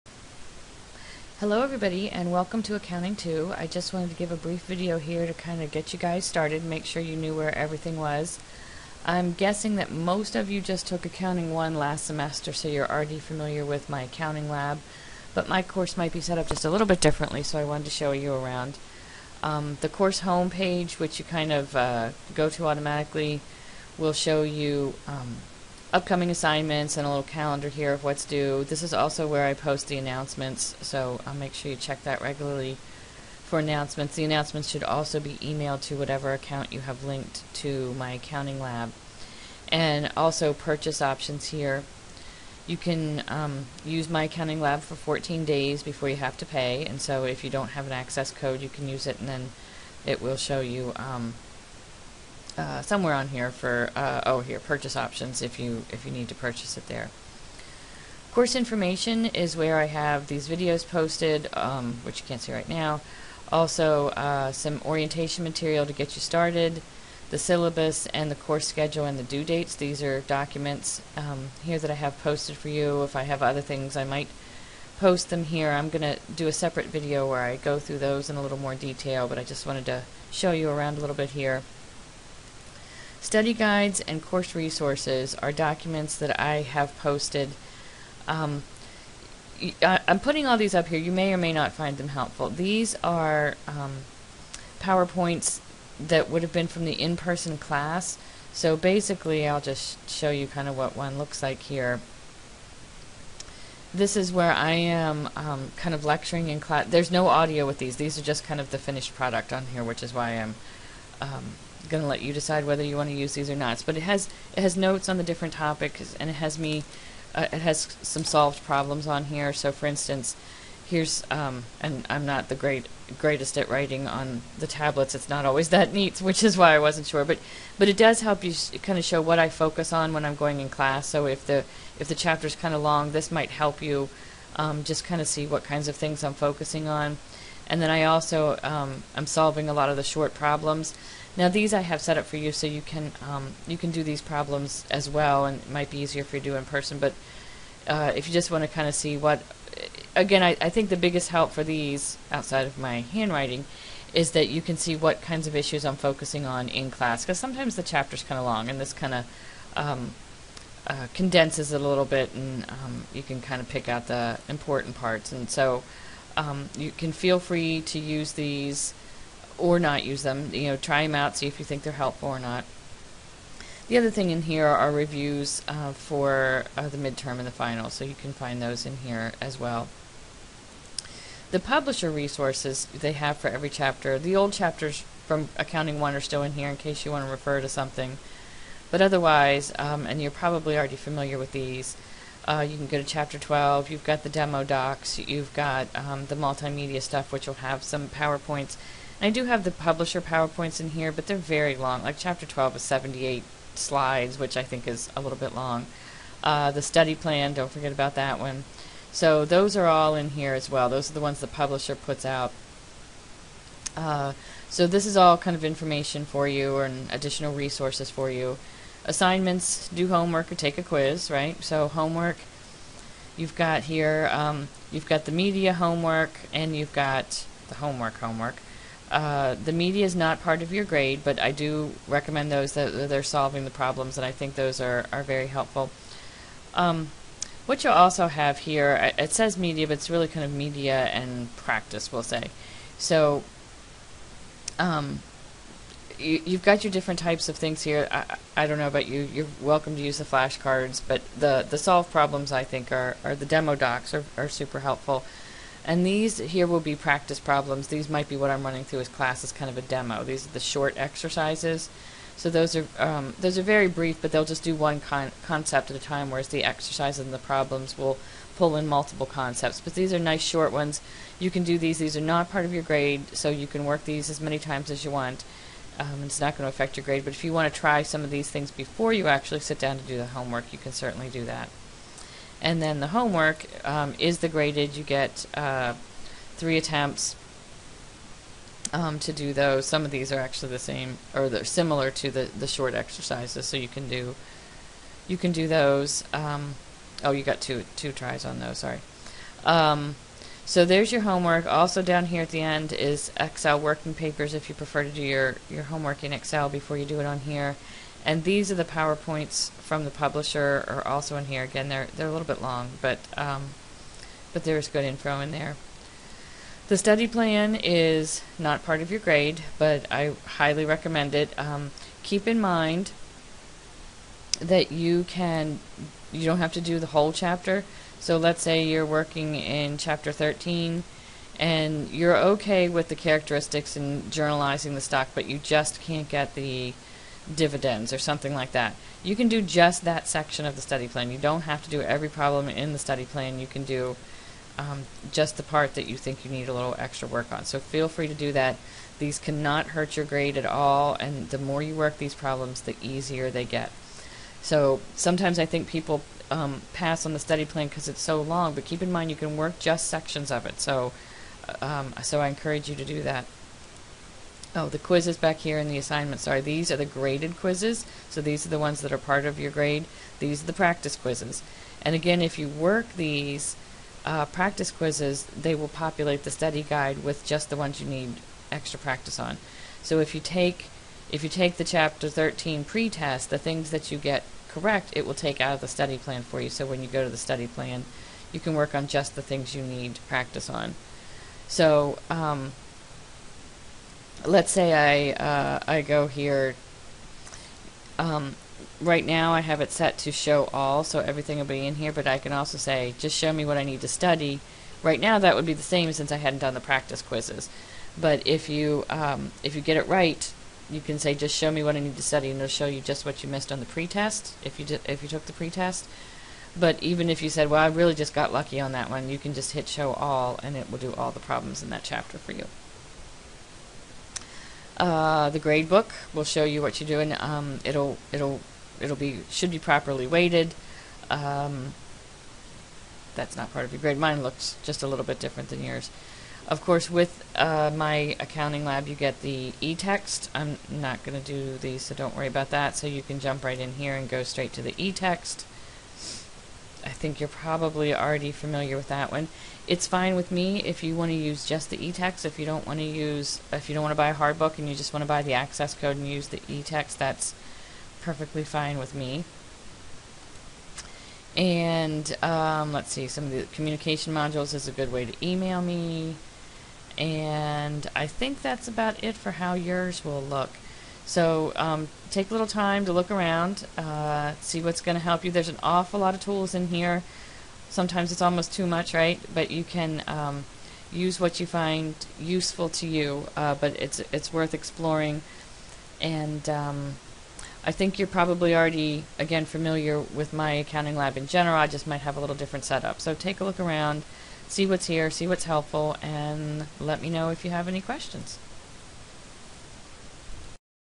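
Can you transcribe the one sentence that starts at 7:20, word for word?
I'm not going to do these, so don't worry about that.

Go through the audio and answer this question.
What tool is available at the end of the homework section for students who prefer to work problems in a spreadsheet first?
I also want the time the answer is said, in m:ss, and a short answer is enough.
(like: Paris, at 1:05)
Excel working papers, at 5:03.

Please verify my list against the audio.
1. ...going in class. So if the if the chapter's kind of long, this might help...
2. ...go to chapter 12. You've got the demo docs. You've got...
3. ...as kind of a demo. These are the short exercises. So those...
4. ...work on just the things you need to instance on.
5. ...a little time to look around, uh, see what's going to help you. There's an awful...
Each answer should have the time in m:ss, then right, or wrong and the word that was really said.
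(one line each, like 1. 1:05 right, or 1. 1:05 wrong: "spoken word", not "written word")
1. 2:10 right
2. 3:12 right
3. 4:19 right
4. 6:28 wrong: "practice", not "instance"
5. 7:52 right.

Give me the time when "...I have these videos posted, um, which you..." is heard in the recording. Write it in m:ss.
0:59.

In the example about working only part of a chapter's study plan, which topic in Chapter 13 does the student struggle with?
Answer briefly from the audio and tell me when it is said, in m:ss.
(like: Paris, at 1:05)
dividends, at 5:36.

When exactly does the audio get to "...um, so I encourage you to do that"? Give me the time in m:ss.
6:02.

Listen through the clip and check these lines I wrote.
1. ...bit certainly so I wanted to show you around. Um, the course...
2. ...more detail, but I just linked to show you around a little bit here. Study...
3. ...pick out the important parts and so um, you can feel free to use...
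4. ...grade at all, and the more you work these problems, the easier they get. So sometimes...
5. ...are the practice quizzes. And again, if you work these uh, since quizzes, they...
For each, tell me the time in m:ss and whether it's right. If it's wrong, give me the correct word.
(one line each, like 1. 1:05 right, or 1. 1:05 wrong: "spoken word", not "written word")
1. 0:16 wrong: "differently", not "certainly"
2. 1:18 wrong: "wanted", not "linked"
3. 2:43 right
4. 5:50 right
5. 6:10 wrong: "practice", not "since".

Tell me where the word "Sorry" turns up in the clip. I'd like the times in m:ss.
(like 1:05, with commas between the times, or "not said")
4:58, 6:06.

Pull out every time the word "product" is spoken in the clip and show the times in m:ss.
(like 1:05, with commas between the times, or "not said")
1:49.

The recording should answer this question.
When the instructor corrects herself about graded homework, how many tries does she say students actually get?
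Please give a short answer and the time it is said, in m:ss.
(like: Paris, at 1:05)
2, at 4:57.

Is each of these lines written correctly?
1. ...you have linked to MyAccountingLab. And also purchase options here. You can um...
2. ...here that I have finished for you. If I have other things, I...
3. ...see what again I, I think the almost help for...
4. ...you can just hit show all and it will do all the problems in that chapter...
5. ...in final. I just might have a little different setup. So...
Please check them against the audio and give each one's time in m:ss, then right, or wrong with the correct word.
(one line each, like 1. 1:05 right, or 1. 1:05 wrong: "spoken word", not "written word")
1. 0:36 right
2. 1:11 wrong: "posted", not "finished"
3. 2:28 wrong: "biggest", not "almost"
4. 6:59 right
5. 8:11 wrong: "general", not "final".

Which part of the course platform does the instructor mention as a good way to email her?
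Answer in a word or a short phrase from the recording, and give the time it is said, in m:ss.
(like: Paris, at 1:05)
communication modules, at 7:43.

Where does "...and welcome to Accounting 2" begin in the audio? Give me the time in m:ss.
0:02.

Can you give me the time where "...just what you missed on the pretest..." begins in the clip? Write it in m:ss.
6:53.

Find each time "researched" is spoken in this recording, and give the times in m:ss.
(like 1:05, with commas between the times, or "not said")
not said.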